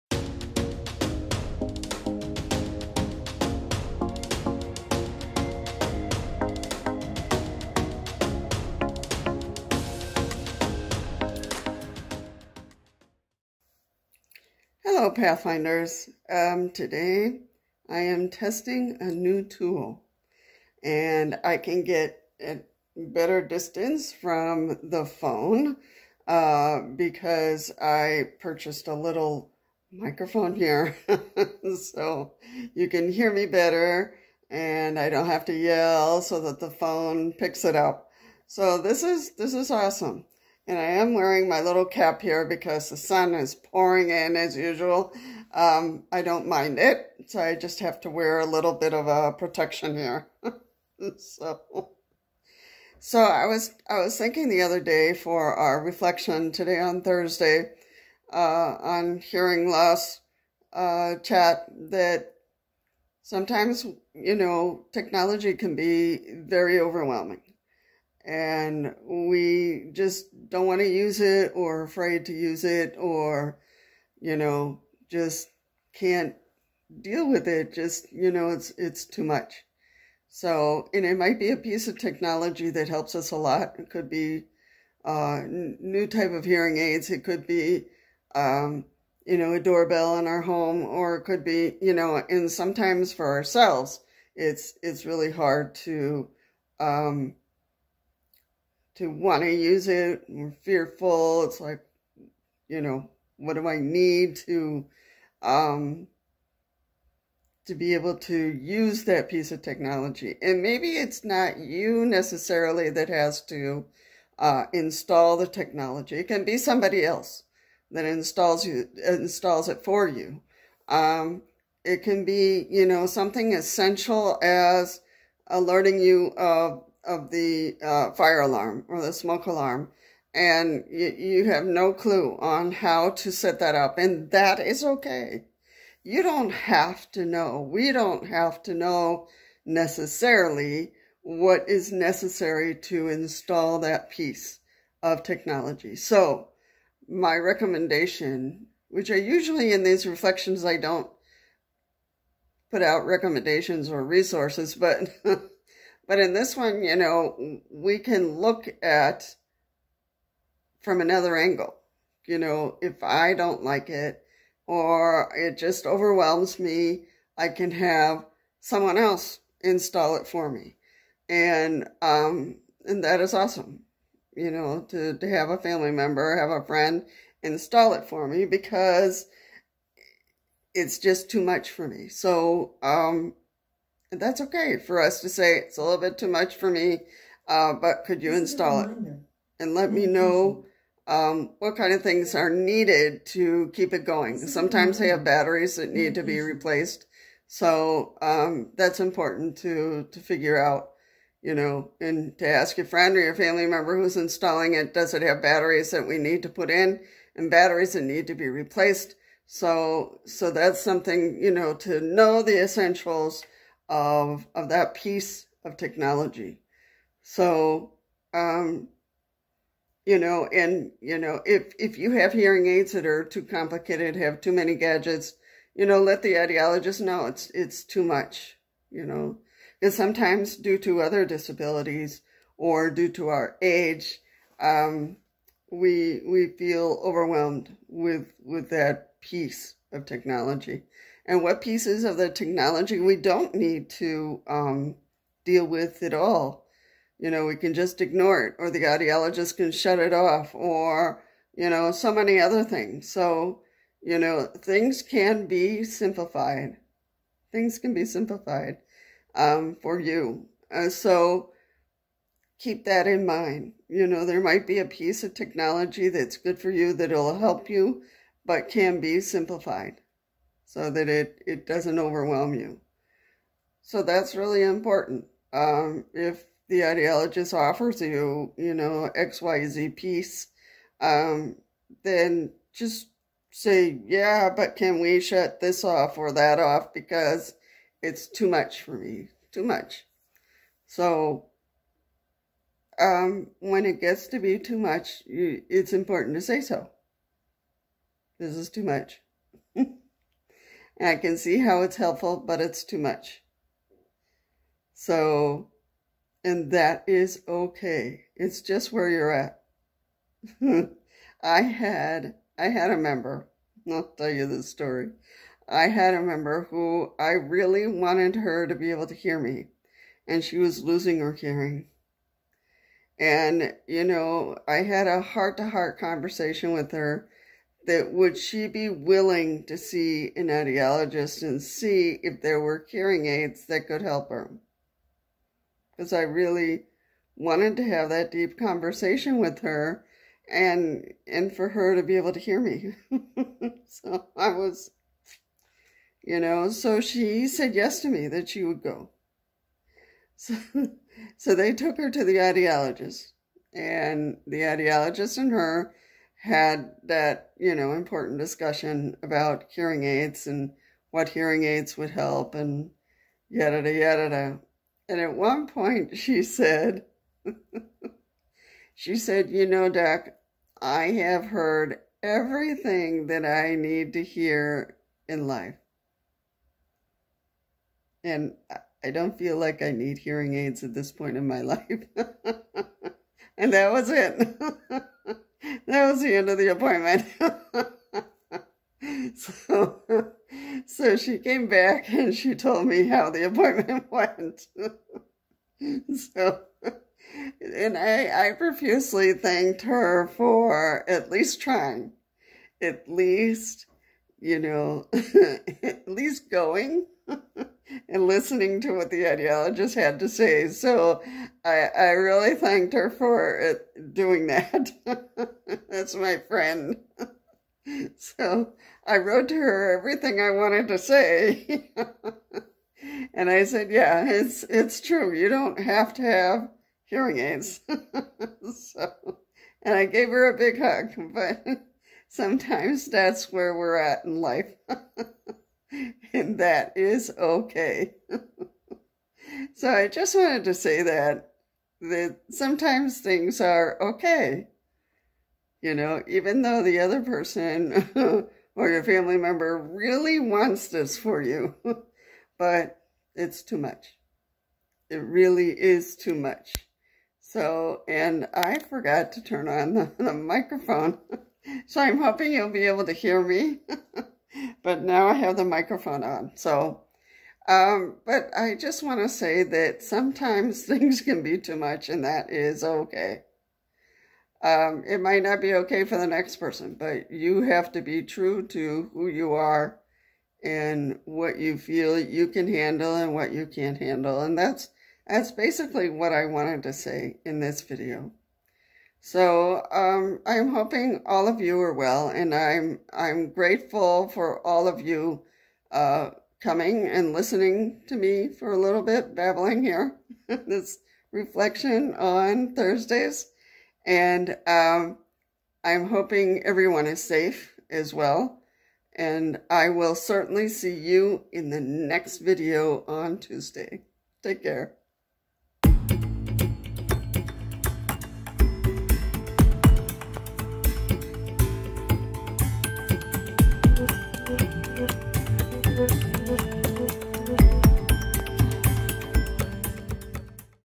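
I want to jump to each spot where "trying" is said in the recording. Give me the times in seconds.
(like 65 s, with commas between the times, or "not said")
401 s.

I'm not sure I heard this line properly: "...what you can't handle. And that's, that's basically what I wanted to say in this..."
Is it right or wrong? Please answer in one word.
right.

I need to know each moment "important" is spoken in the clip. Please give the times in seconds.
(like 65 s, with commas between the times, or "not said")
198 s, 274 s, 295 s, 357 s.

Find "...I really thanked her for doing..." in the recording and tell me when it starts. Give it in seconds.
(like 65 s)
411 s.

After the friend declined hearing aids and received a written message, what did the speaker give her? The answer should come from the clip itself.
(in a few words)
a big hug.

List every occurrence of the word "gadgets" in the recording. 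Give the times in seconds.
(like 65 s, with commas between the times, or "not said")
224 s.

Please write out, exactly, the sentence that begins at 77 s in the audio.
Just, you know, it's, it's too much.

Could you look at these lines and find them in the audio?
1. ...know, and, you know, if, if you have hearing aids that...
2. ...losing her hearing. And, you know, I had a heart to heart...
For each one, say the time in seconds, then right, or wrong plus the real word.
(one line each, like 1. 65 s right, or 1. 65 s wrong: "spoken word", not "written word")
1. 220 s right
2. 320 s right.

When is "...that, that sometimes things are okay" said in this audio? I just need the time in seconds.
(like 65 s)
441 s.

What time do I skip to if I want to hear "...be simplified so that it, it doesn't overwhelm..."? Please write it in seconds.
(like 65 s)
268 s.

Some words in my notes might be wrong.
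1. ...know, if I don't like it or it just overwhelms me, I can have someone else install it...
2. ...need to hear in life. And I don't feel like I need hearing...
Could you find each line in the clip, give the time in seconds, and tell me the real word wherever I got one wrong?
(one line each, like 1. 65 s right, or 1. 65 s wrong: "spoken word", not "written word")
1. 162 s right
2. 373 s right.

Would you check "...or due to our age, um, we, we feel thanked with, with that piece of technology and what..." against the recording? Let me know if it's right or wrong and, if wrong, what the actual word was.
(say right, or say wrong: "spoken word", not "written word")
wrong: "overwhelmed", not "thanked".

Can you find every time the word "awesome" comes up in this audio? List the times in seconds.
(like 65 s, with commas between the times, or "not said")
39 s, 173 s.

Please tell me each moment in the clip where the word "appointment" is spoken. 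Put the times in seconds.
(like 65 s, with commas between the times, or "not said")
386 s, 393 s.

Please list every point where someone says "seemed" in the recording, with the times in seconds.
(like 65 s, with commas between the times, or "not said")
not said.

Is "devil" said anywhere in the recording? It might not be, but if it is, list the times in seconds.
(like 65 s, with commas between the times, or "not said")
not said.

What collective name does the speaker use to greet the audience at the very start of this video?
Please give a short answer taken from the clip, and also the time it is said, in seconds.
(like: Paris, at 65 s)
Pathfinders, at 15 s.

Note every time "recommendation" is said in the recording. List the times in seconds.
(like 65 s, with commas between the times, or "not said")
147 s, 153 s.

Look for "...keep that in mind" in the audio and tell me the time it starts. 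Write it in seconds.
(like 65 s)
262 s.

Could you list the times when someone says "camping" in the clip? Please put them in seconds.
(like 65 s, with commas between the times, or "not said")
not said.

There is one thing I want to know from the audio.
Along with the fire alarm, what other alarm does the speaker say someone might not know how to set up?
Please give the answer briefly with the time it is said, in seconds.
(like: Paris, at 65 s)
smoke alarm, at 129 s.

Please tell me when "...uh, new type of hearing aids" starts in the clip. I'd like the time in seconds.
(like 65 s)
85 s.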